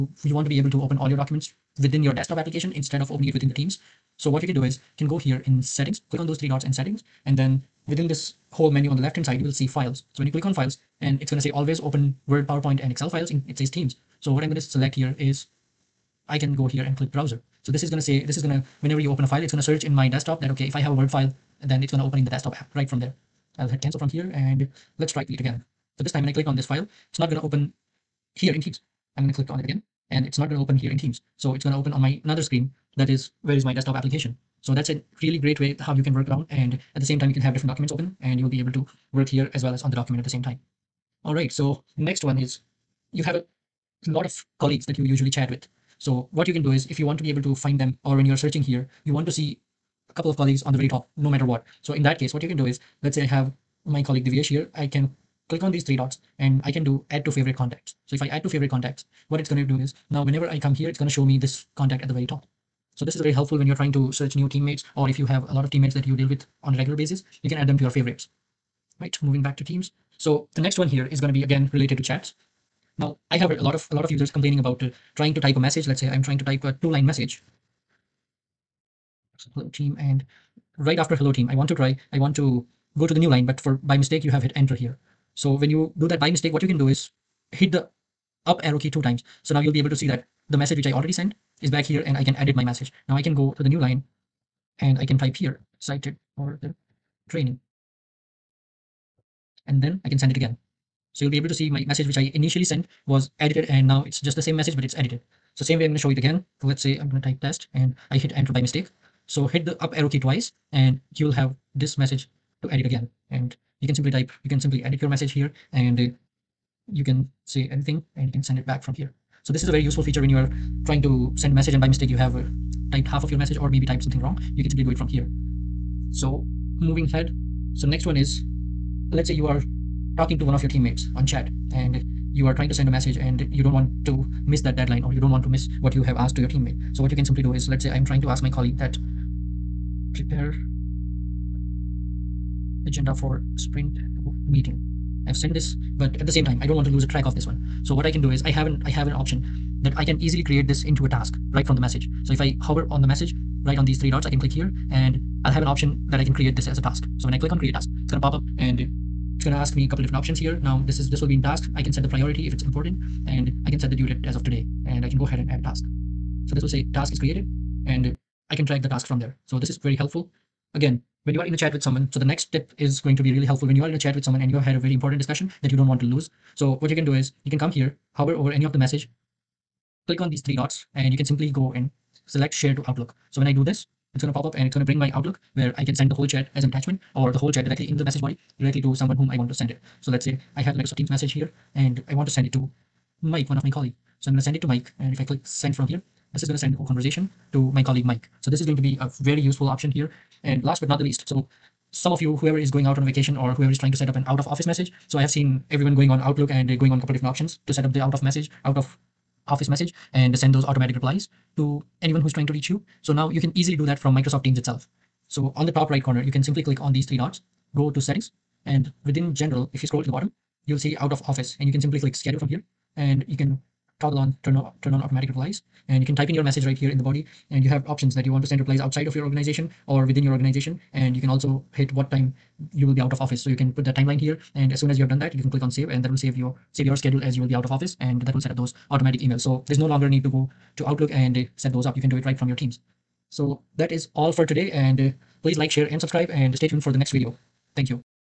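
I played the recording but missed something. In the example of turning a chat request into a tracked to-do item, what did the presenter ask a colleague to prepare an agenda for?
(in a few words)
sprint meeting.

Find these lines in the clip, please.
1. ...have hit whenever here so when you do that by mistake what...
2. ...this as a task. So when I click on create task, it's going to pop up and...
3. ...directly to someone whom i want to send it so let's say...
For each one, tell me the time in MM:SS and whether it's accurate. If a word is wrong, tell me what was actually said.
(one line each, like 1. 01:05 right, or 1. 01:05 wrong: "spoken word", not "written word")
1. 01:24 wrong: "enter", not "whenever"
2. 02:36 right
3. 03:08 right.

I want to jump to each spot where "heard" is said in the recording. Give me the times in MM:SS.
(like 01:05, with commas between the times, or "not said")
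01:13.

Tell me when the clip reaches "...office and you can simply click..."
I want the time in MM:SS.
03:41.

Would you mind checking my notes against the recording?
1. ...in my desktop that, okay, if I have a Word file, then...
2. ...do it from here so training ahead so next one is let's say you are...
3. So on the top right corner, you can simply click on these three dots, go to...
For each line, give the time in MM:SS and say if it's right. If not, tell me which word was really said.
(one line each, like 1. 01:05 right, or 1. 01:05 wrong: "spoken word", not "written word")
1. 00:19 right
2. 02:04 wrong: "moving", not "training"
3. 03:35 right.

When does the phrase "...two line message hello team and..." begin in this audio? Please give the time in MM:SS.
01:16.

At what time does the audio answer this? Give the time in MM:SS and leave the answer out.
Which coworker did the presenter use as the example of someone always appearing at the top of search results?
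00:54.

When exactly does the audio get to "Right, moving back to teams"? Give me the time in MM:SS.
01:09.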